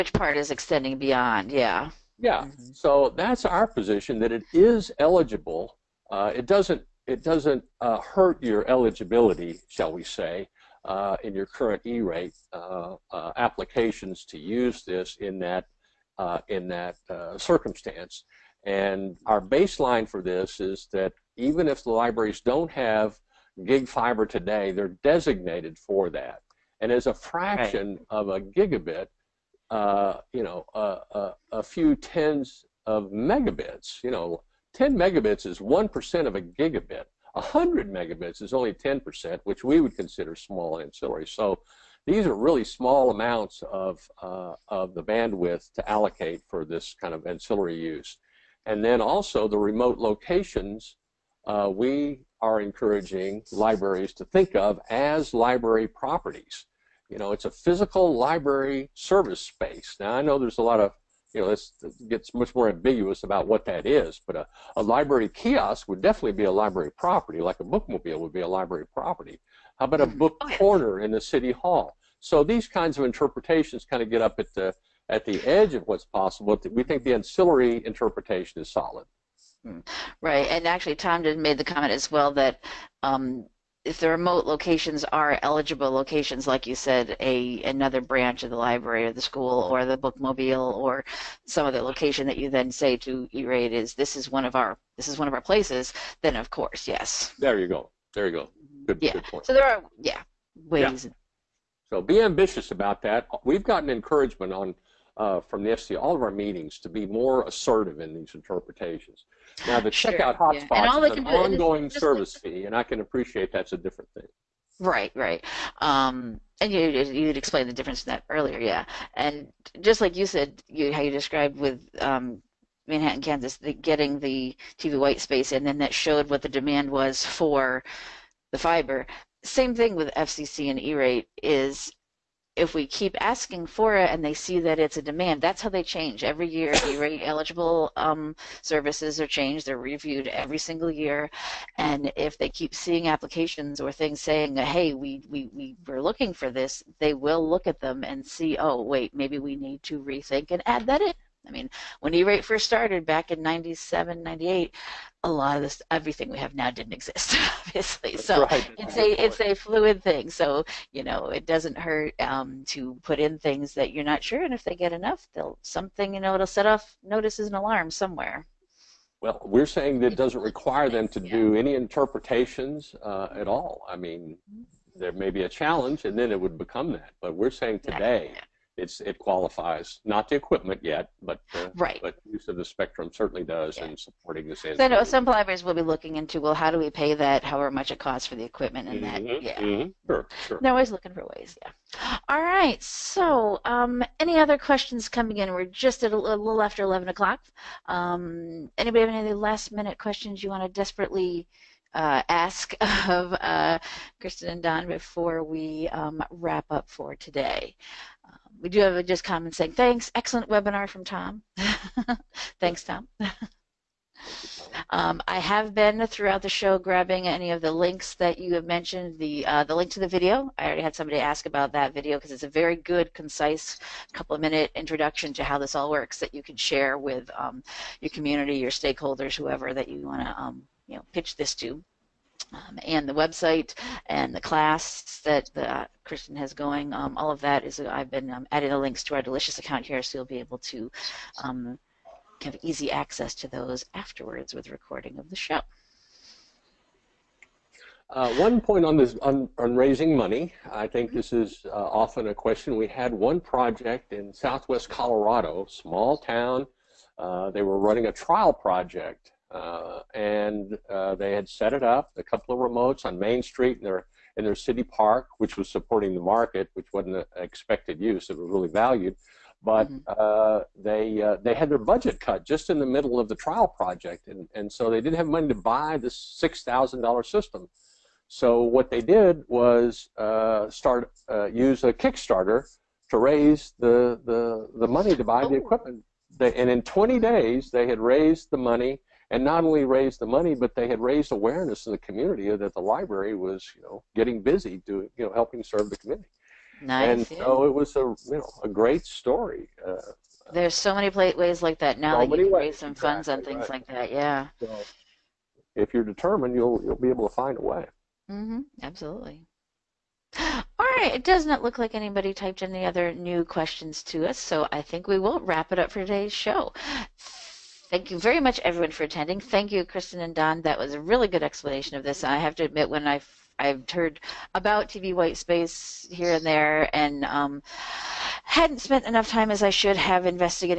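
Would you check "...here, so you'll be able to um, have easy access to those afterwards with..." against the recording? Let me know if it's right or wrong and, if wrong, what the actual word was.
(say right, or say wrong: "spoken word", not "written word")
right.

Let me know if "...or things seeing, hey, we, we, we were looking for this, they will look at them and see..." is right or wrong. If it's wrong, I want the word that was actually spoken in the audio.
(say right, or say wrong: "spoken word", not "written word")
wrong: "saying", not "seeing".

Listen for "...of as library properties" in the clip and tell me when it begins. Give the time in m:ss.
0:54.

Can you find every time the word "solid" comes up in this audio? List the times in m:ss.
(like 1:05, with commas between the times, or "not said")
1:18.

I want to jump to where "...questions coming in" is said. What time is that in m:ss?
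3:14.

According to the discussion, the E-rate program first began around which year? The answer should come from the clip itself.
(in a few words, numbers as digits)
1997.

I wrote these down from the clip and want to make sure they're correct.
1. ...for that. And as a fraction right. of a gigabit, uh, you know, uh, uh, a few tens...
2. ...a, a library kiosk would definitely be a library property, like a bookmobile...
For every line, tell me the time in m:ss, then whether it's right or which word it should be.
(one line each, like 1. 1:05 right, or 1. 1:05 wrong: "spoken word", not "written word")
1. 0:25 right
2. 1:04 right.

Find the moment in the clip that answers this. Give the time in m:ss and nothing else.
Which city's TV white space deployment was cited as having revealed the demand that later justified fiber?
2:02.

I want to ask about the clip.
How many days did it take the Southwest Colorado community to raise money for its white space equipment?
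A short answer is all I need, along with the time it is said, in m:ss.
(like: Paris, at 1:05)
20, at 4:46.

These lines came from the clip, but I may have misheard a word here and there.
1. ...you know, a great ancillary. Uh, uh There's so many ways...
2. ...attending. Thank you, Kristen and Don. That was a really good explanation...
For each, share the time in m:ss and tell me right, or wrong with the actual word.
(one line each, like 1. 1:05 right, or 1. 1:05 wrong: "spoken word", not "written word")
1. 4:57 wrong: "story", not "ancillary"
2. 5:19 right.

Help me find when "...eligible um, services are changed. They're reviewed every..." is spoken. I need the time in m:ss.
2:17.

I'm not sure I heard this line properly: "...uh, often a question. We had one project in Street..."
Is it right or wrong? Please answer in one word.
wrong.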